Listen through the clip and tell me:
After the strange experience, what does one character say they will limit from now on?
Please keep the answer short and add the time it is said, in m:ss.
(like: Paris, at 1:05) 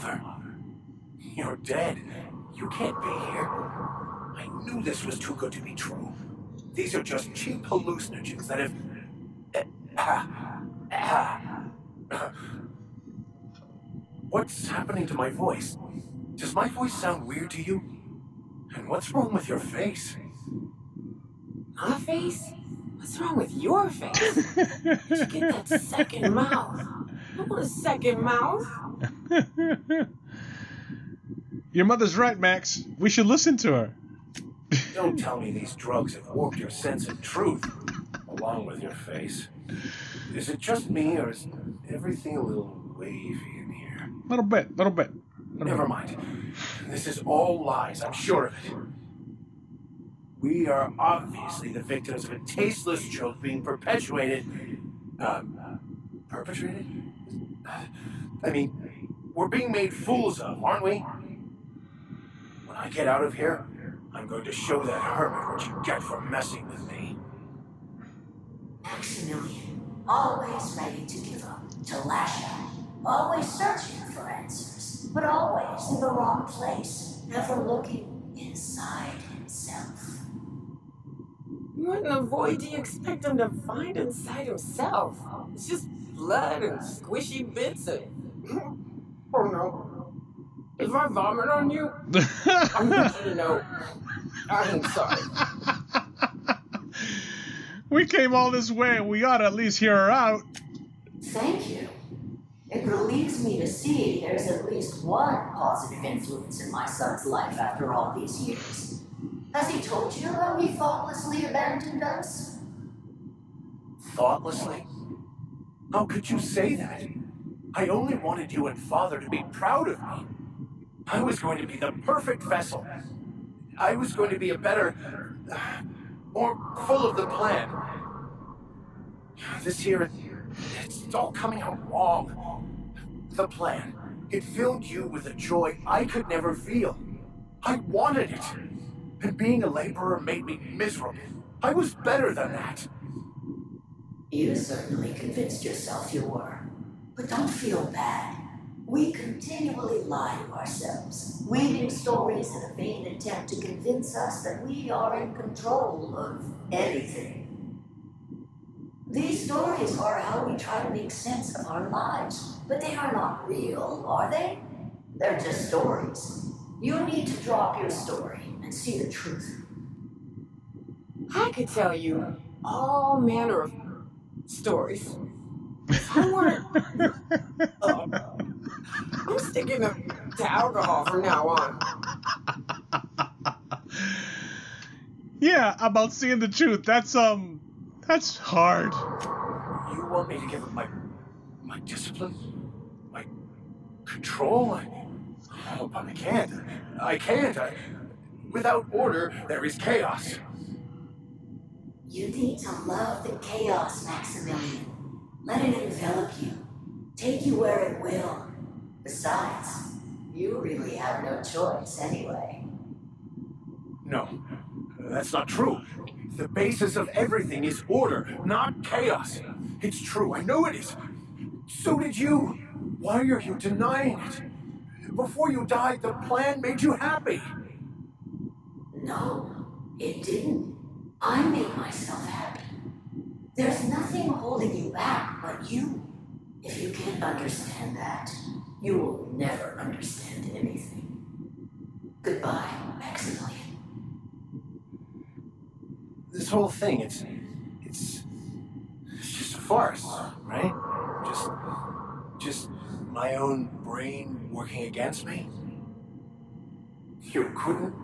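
Alcohol, at 3:00.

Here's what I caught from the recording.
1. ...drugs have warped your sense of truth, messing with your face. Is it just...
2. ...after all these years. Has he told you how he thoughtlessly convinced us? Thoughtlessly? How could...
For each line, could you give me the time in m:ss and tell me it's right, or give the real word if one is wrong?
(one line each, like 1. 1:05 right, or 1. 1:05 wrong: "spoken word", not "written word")
1. 0:35 wrong: "along", not "messing"
2. 1:47 wrong: "abandoned", not "convinced".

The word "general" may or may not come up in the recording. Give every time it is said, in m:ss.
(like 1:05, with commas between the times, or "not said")
not said.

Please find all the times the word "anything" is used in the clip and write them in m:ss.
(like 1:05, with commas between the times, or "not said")
2:36, 4:00.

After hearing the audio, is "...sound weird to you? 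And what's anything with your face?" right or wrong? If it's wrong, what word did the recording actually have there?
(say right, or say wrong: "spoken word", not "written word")
wrong: "wrong", not "anything".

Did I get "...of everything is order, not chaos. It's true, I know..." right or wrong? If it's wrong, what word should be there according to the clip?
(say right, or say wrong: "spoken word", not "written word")
right.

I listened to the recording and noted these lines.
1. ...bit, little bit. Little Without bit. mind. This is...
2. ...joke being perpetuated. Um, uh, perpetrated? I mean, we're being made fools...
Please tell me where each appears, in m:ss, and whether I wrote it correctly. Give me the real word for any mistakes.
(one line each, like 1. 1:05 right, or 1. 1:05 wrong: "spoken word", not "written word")
1. 0:44 wrong: "Never", not "Without"
2. 0:53 right.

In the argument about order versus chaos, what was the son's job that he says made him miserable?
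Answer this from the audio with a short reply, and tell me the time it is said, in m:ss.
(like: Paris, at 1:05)
Laborer, at 2:19.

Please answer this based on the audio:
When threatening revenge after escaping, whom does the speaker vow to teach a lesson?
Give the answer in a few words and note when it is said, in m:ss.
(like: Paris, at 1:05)
That hermit, at 1:05.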